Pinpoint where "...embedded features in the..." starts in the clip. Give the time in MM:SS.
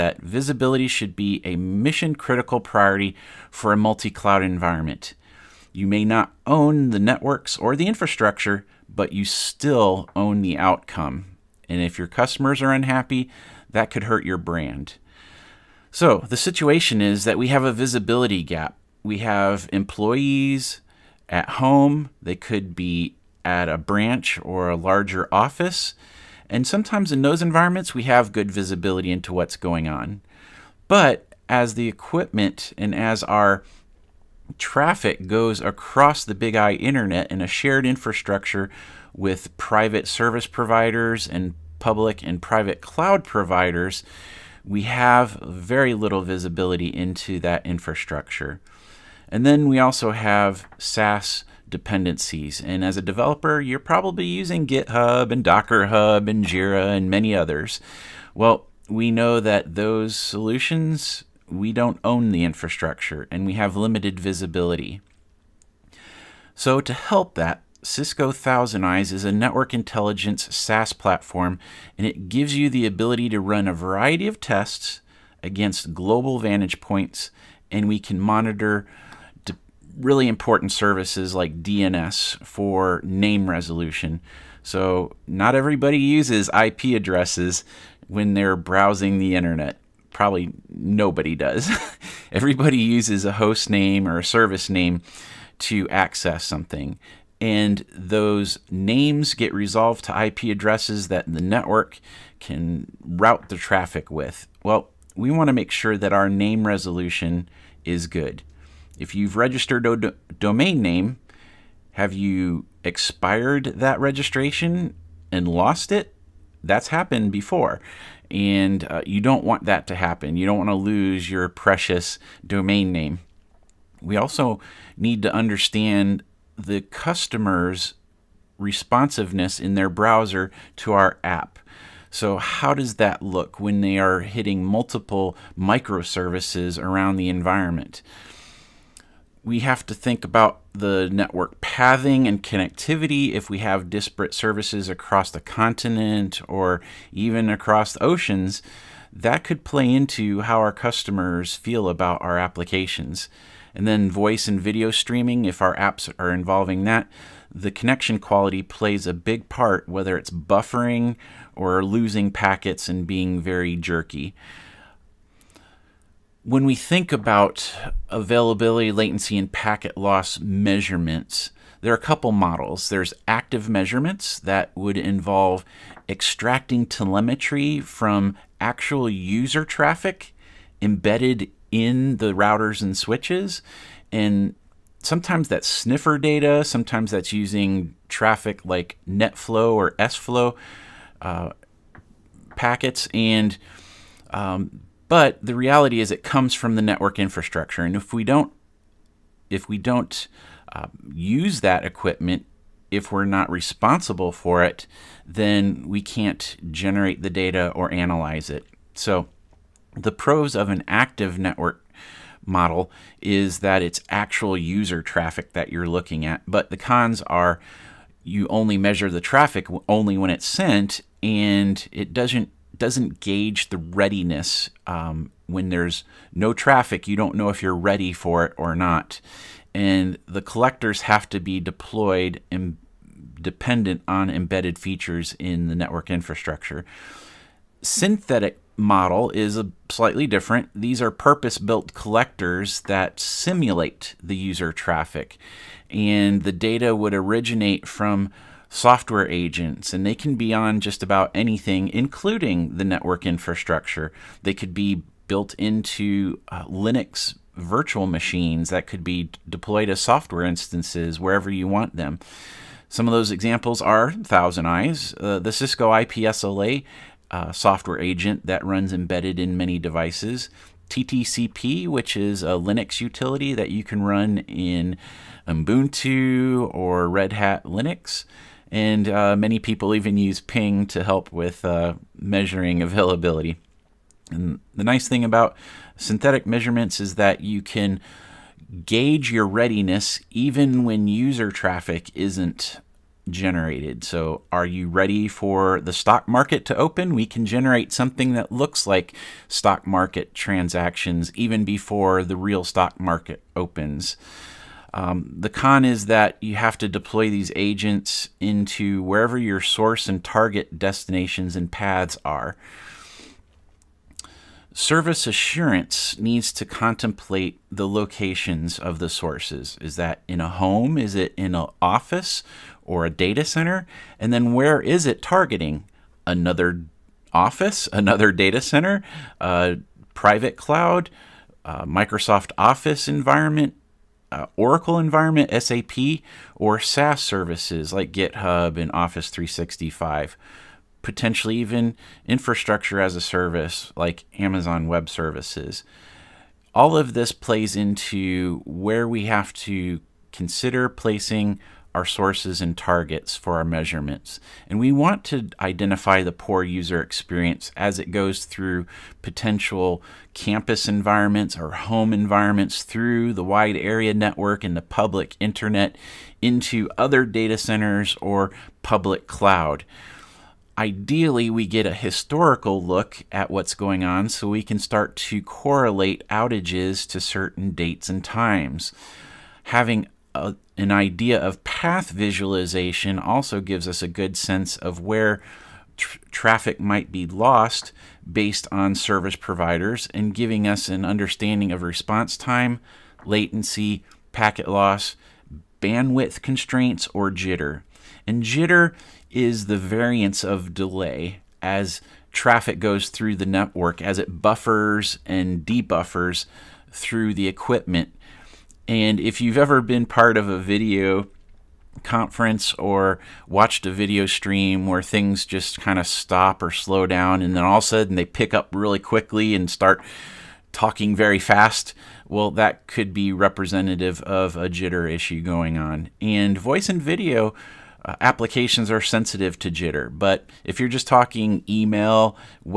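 03:54.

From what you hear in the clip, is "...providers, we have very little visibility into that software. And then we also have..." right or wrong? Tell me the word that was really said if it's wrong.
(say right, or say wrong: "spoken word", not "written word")
wrong: "infrastructure", not "software".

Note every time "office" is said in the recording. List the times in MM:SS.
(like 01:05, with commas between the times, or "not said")
00:25, 05:21, 05:27, 05:32, 05:38.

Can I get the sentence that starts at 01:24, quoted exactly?
So not everybody uses IP addresses when they're browsing the internet probably nobody does.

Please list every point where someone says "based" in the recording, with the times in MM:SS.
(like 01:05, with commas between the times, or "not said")
06:28.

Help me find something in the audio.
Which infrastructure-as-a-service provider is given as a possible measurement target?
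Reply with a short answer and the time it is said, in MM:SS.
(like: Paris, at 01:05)
Amazon Web Services, at 05:44.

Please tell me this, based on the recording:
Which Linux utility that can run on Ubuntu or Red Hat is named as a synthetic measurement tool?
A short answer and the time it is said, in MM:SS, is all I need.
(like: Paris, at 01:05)
TTCP, at 04:30.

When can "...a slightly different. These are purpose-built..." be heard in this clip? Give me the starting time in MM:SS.
03:59.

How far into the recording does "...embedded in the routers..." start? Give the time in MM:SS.
03:00.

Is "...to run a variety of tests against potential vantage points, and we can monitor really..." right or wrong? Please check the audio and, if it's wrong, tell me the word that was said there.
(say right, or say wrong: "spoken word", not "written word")
wrong: "global", not "potential".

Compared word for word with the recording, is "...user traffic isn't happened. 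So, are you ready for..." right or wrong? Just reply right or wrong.
wrong.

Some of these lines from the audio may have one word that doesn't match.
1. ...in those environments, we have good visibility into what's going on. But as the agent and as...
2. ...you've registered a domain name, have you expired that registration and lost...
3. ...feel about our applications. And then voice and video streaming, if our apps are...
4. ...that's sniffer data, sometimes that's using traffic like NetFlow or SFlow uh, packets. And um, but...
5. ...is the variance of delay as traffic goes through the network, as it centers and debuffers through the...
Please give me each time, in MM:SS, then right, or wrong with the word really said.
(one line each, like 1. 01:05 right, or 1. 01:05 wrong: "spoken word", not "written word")
1. 00:27 wrong: "equipment", not "agent"
2. 01:49 right
3. 02:31 right
4. 03:05 right
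5. 06:39 wrong: "buffers", not "centers".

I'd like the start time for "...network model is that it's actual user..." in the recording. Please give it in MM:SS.
03:31.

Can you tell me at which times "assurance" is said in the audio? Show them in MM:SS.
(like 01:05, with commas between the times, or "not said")
05:15.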